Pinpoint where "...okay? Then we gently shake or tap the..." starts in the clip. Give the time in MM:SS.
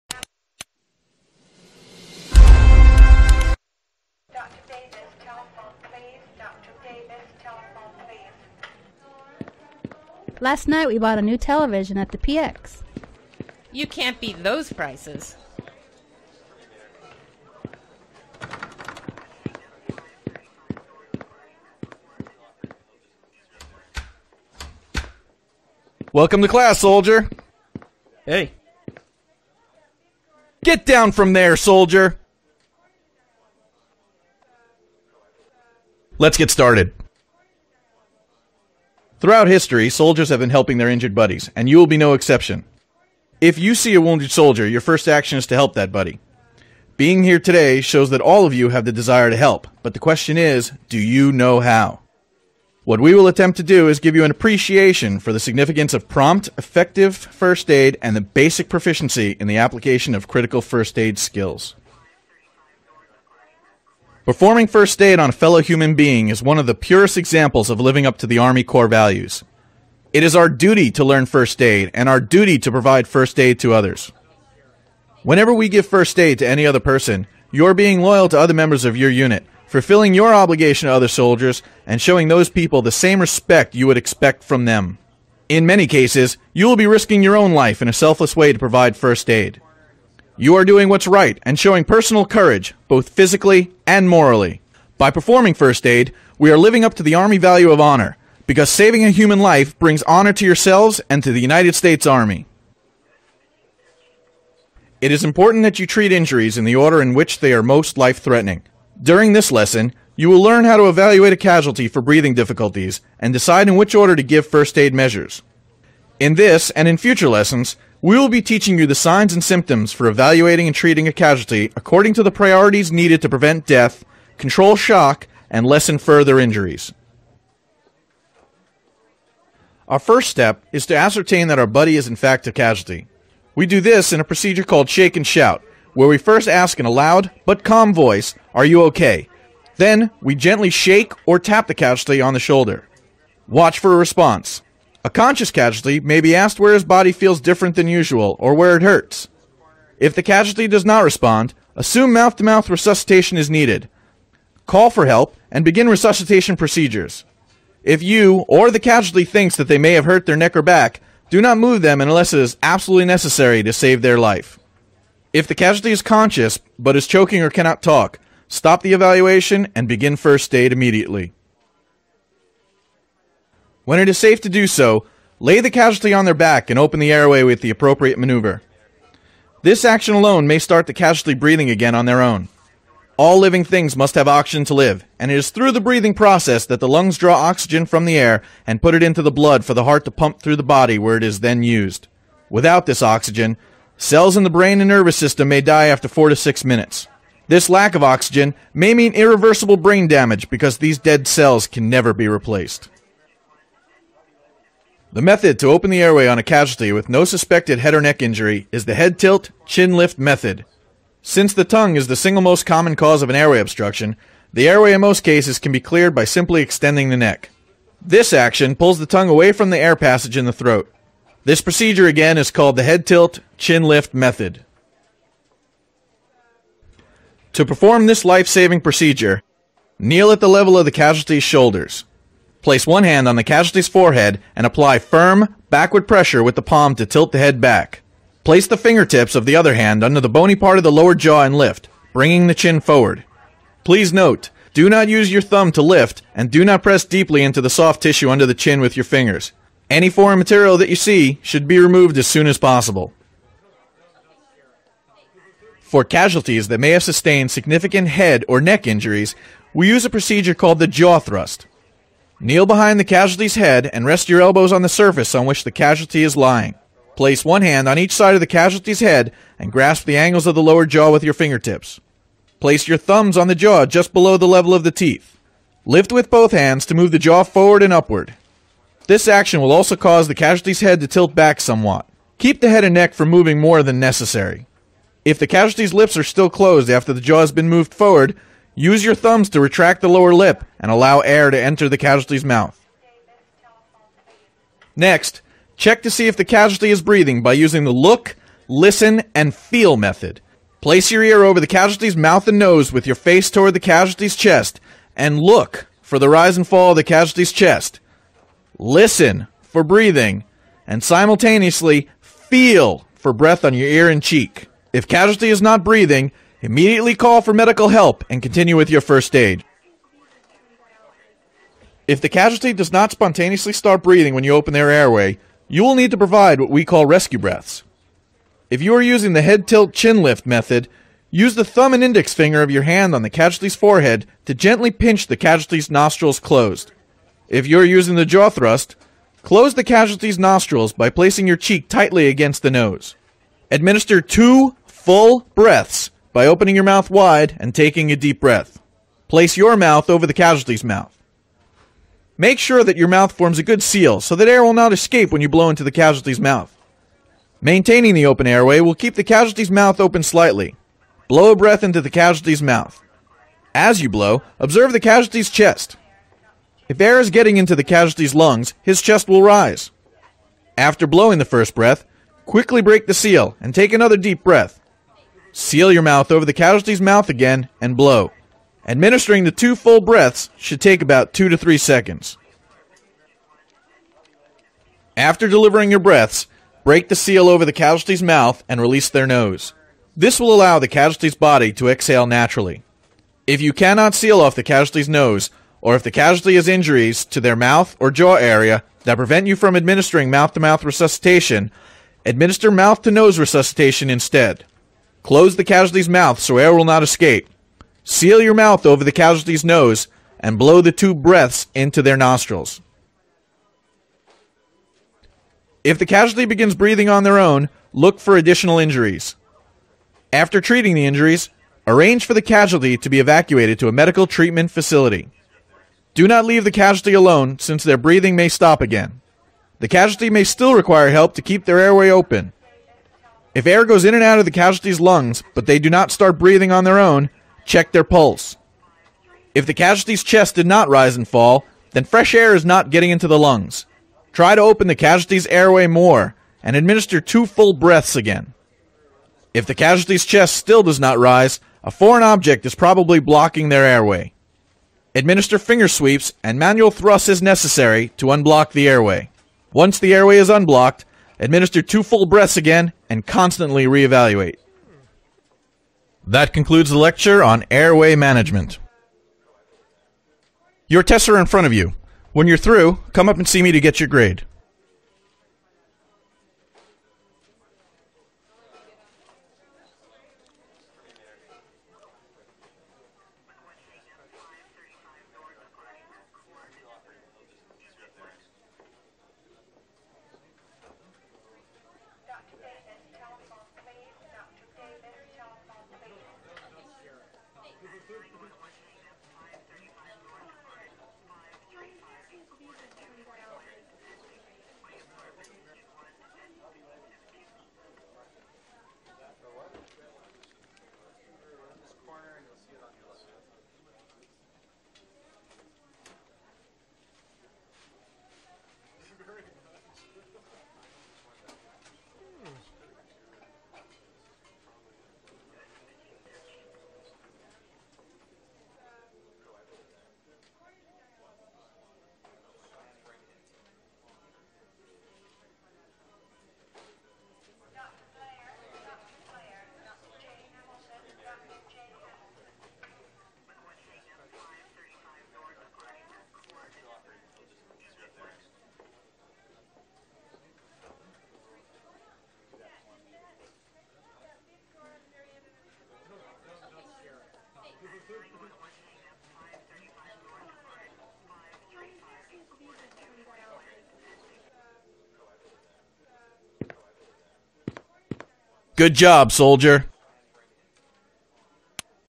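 02:18.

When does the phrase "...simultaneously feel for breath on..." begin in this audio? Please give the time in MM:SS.
05:11.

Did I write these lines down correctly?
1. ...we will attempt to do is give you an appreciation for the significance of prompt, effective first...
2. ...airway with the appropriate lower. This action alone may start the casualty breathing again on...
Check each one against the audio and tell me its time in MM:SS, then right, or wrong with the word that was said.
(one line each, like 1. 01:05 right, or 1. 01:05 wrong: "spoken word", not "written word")
1. 00:52 right
2. 02:57 wrong: "maneuver", not "lower".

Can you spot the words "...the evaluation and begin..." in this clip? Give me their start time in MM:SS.
02:48.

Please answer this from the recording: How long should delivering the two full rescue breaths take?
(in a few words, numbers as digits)
2 to 3 seconds.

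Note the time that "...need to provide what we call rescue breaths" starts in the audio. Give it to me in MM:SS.
05:25.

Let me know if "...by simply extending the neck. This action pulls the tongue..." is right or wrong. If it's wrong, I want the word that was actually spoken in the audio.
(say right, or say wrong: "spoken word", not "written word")
right.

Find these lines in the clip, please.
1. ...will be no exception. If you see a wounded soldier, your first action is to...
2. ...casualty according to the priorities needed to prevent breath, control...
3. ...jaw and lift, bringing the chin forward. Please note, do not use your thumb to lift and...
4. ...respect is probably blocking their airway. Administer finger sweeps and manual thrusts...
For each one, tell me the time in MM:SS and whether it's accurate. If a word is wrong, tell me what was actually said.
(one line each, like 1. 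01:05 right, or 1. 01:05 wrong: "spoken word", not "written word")
1. 00:41 right
2. 02:01 wrong: "death", not "breath"
3. 04:01 right
4. 07:32 wrong: "object", not "respect".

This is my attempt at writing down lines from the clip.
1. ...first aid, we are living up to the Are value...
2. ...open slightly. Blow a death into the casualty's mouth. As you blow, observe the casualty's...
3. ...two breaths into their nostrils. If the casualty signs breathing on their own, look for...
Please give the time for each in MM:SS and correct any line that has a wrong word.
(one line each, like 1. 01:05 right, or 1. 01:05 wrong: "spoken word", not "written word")
1. 01:35 wrong: "Army", not "Are"
2. 05:59 wrong: "breath", not "death"
3. 06:50 wrong: "begins", not "signs".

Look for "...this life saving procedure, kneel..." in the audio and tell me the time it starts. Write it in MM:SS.
03:48.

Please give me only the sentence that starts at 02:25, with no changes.
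A conscious casualty may be asked where his body feels different than usual or where it hurts.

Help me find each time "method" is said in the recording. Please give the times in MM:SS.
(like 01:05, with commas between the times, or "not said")
03:25, 03:30, 03:44, 04:59, 05:30.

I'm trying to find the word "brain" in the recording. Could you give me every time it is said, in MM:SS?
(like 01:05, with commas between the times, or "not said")
03:14, 03:19.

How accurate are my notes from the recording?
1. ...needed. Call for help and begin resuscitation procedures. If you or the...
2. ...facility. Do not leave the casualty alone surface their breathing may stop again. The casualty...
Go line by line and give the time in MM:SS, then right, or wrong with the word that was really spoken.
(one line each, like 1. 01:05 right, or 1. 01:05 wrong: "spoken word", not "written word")
1. 02:33 right
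2. 07:04 wrong: "since", not "surface".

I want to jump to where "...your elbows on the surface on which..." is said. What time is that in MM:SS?
04:24.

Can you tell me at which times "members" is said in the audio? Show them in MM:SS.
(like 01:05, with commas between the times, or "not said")
01:18.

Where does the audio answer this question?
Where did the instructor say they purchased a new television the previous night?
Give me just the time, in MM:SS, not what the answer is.
00:12.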